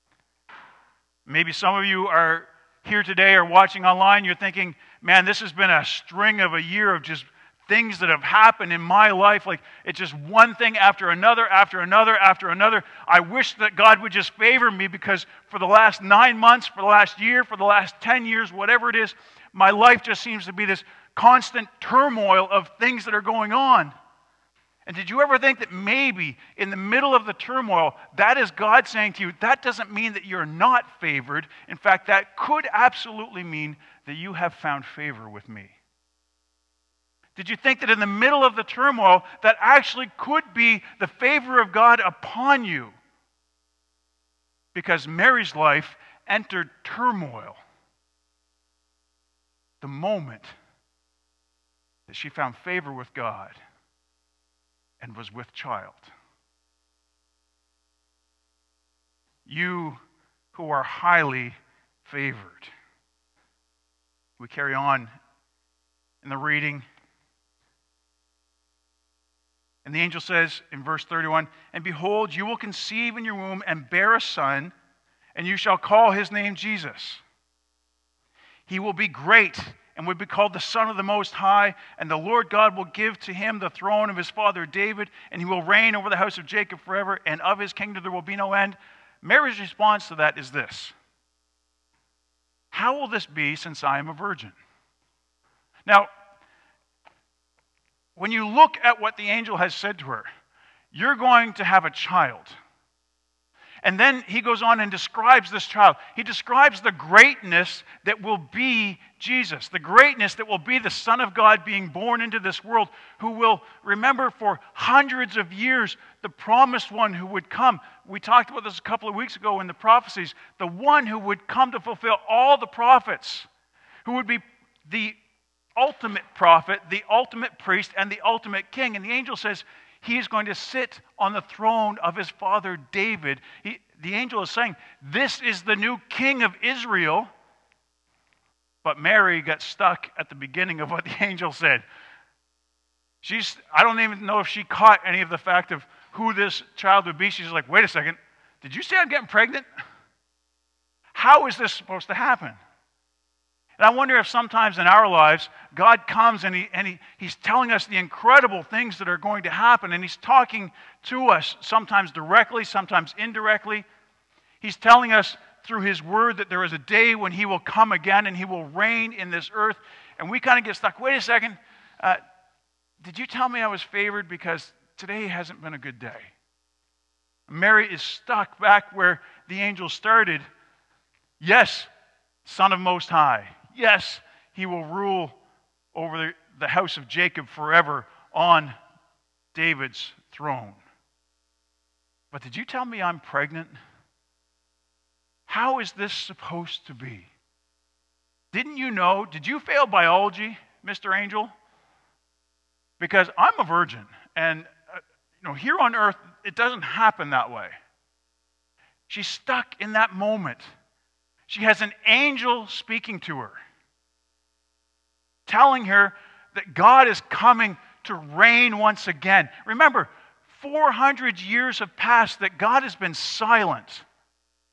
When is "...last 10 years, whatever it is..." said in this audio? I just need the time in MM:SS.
00:17.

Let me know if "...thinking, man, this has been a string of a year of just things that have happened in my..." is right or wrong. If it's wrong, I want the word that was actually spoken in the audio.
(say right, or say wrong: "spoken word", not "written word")
right.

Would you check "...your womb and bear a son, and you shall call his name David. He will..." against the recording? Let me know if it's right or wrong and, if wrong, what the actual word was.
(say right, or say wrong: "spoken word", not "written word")
wrong: "Jesus", not "David".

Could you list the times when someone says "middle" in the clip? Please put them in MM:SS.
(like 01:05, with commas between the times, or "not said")
00:26, 00:38.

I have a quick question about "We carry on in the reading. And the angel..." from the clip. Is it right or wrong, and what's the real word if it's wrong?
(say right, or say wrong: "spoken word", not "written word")
right.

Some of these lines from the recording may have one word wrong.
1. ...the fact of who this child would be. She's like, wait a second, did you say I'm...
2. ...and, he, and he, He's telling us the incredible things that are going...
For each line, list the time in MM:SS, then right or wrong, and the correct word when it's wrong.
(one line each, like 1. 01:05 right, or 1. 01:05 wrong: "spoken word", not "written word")
1. 02:25 right
2. 02:36 right.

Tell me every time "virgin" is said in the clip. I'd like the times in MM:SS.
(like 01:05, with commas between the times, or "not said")
01:34, 03:23.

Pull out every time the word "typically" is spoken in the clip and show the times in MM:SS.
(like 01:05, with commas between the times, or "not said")
not said.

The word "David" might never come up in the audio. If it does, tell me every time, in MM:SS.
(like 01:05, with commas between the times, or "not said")
01:24, 02:12, 03:09.